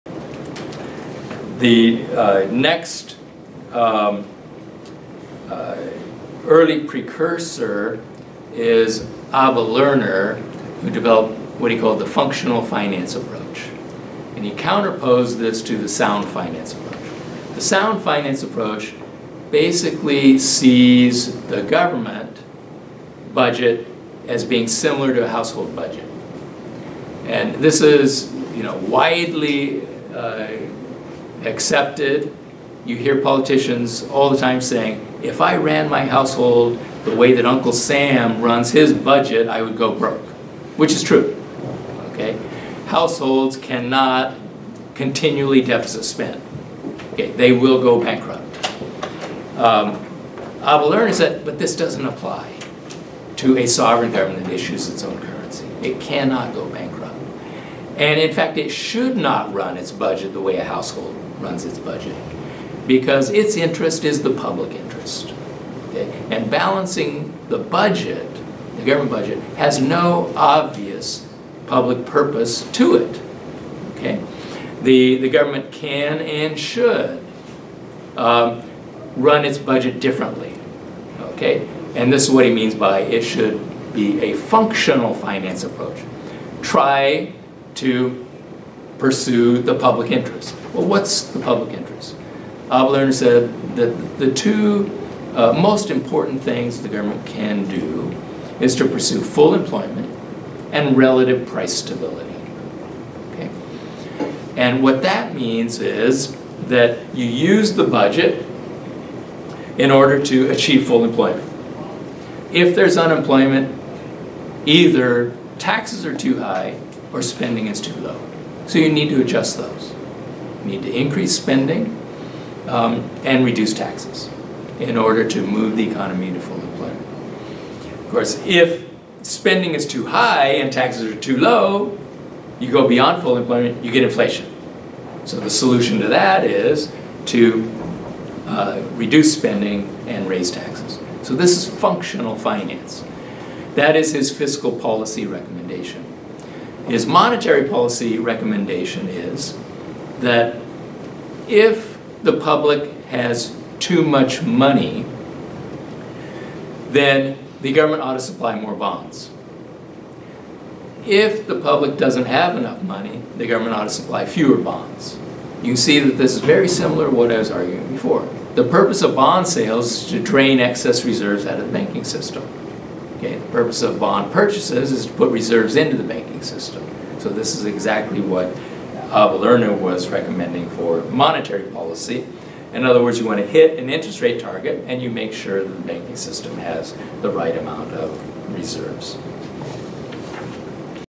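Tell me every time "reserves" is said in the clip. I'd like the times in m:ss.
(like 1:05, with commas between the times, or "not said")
2:51, 2:55, 3:08.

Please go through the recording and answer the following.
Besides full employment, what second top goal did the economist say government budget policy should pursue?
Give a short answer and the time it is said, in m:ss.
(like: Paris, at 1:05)
relative price stability, at 1:40.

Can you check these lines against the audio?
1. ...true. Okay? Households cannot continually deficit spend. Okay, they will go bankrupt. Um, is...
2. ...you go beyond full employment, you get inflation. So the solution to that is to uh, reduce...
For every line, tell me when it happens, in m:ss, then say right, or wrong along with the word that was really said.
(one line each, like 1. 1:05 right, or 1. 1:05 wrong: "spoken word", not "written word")
1. 0:41 right
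2. 2:12 right.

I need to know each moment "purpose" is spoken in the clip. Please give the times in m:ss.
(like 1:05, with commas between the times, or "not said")
1:12, 2:48, 2:53.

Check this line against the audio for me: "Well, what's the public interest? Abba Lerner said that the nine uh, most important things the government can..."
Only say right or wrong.
wrong.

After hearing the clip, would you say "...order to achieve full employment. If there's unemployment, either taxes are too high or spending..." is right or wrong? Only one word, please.
right.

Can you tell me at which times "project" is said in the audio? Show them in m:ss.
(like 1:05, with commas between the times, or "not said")
not said.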